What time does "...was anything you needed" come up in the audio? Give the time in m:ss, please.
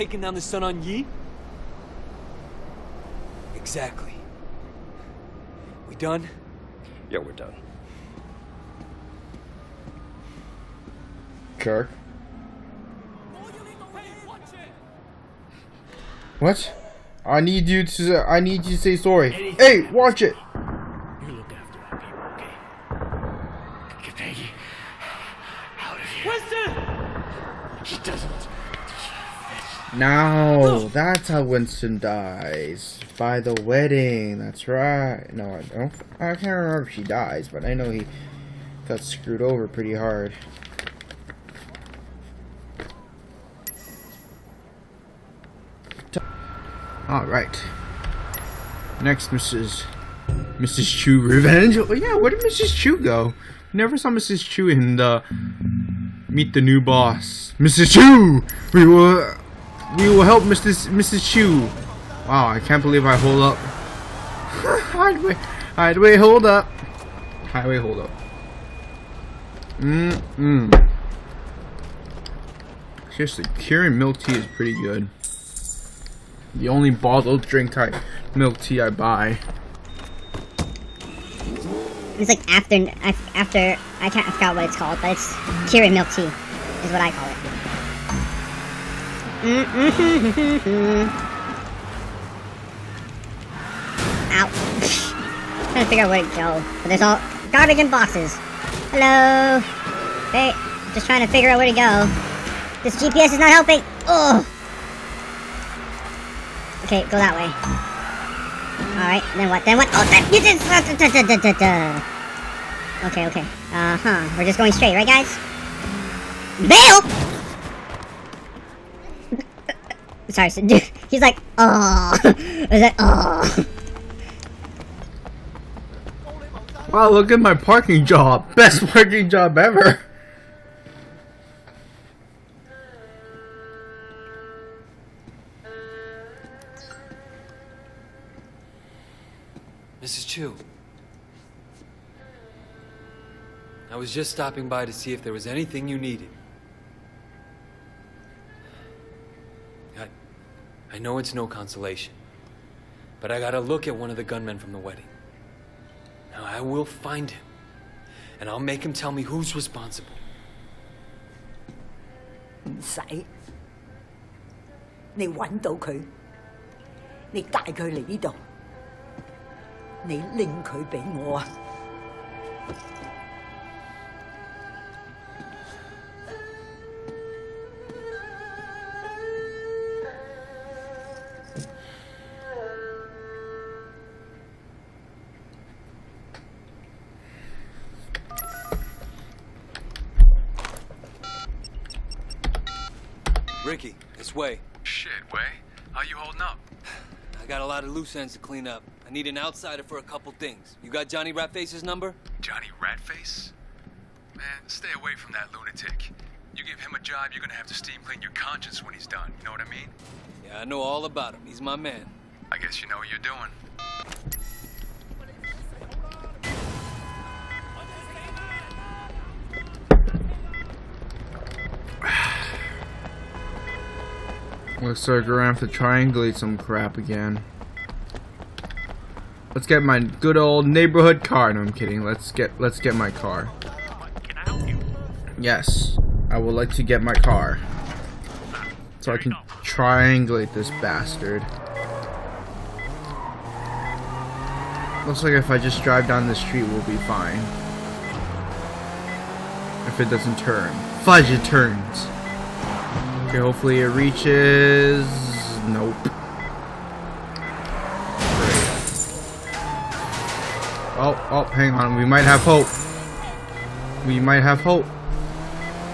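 2:25.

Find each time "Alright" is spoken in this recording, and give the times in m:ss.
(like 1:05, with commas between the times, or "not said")
0:47, 1:48.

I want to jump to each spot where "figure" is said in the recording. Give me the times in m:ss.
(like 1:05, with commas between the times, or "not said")
1:35, 1:41.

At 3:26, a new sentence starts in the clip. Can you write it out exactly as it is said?
You give him a job, you're gonna have to steam clean your conscience when he's done.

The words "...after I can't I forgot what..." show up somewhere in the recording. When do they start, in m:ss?
1:23.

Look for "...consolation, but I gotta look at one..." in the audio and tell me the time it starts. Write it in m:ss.
2:31.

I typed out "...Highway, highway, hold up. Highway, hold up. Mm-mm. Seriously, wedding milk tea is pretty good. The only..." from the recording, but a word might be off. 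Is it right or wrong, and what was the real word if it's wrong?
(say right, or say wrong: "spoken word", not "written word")
wrong: "curing", not "wedding".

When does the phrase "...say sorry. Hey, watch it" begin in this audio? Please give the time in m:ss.
0:18.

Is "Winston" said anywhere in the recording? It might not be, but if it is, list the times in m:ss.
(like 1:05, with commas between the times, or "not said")
0:26, 0:31.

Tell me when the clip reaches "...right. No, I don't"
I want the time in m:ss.
0:34.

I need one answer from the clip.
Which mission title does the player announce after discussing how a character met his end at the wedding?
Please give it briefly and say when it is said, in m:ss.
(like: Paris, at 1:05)
Mrs. Chu Revenge, at 0:50.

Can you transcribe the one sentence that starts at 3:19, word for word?
I need an outsider for a couple things.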